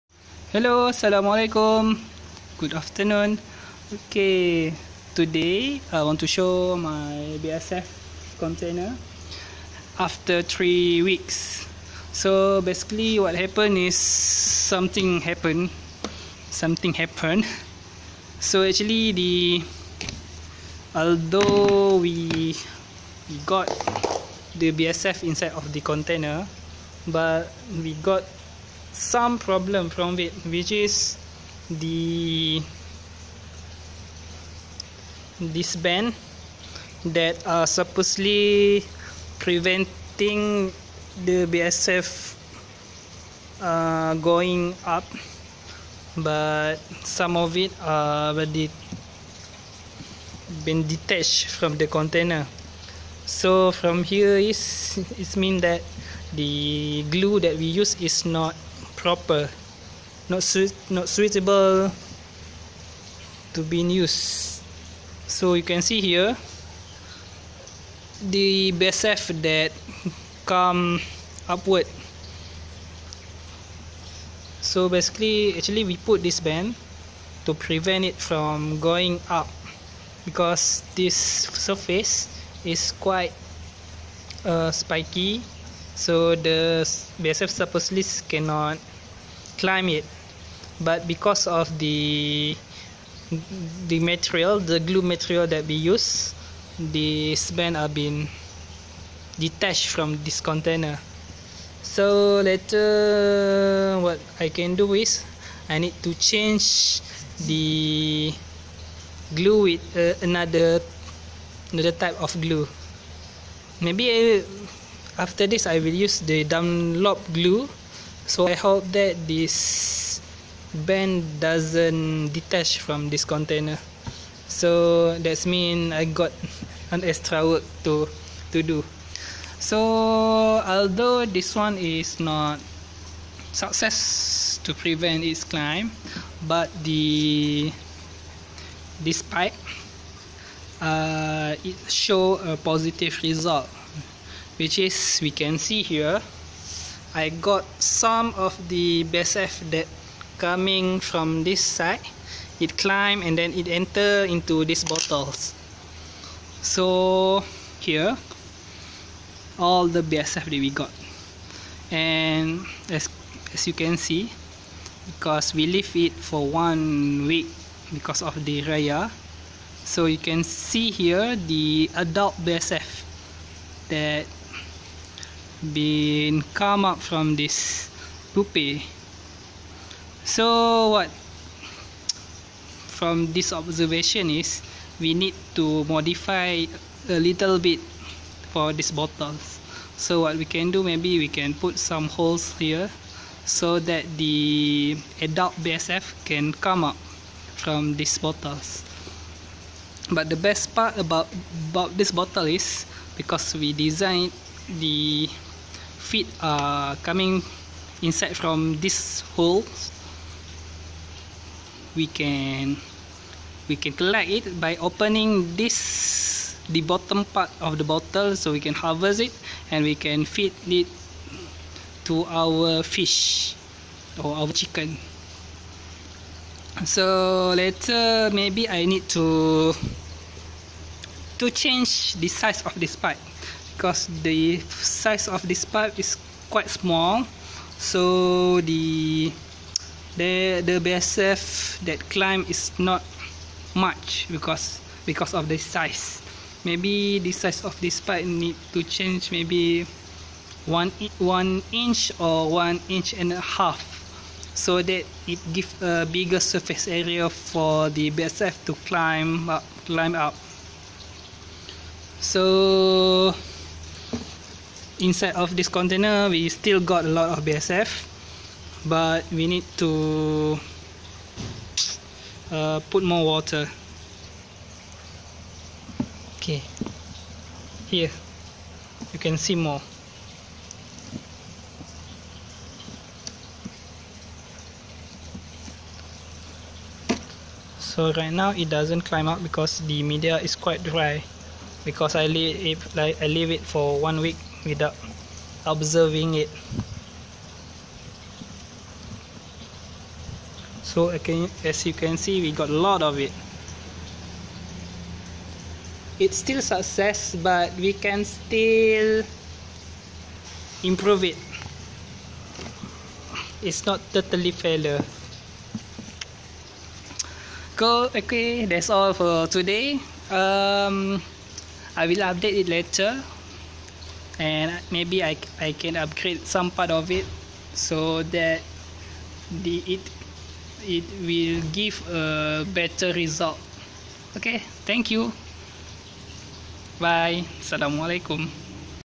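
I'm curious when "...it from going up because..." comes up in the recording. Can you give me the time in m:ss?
1:18.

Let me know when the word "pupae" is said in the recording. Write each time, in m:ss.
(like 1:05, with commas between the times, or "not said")
2:58.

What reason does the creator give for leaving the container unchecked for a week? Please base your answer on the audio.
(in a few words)
Raya.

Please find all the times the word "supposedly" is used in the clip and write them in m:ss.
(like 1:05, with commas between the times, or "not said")
0:37, 1:27.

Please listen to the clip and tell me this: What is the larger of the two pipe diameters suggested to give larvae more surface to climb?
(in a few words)
1.5 inches.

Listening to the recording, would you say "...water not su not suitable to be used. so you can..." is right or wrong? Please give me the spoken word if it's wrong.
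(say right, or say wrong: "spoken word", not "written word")
wrong: "proper", not "water".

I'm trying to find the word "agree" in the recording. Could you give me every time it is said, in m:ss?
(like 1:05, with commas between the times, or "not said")
not said.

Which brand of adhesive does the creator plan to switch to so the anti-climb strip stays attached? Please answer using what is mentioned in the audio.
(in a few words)
Dunlop.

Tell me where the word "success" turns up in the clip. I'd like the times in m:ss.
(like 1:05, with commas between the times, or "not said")
2:13, 5:06.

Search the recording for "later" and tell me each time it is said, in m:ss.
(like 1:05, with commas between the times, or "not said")
1:42, 3:47, 5:22.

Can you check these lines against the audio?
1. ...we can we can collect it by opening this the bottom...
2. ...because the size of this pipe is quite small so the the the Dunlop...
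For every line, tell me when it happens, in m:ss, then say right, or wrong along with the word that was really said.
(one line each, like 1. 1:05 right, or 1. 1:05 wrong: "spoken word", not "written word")
1. 3:31 right
2. 3:53 wrong: "BSF", not "Dunlop".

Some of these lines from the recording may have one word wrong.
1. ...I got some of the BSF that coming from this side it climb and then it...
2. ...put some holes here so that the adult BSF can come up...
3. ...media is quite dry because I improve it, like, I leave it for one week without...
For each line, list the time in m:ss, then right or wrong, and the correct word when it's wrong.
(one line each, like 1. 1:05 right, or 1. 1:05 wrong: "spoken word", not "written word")
1. 2:27 right
2. 3:11 right
3. 4:50 wrong: "leave", not "improve".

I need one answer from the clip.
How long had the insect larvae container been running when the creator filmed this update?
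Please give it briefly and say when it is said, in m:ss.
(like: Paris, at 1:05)
3 weeks, at 0:10.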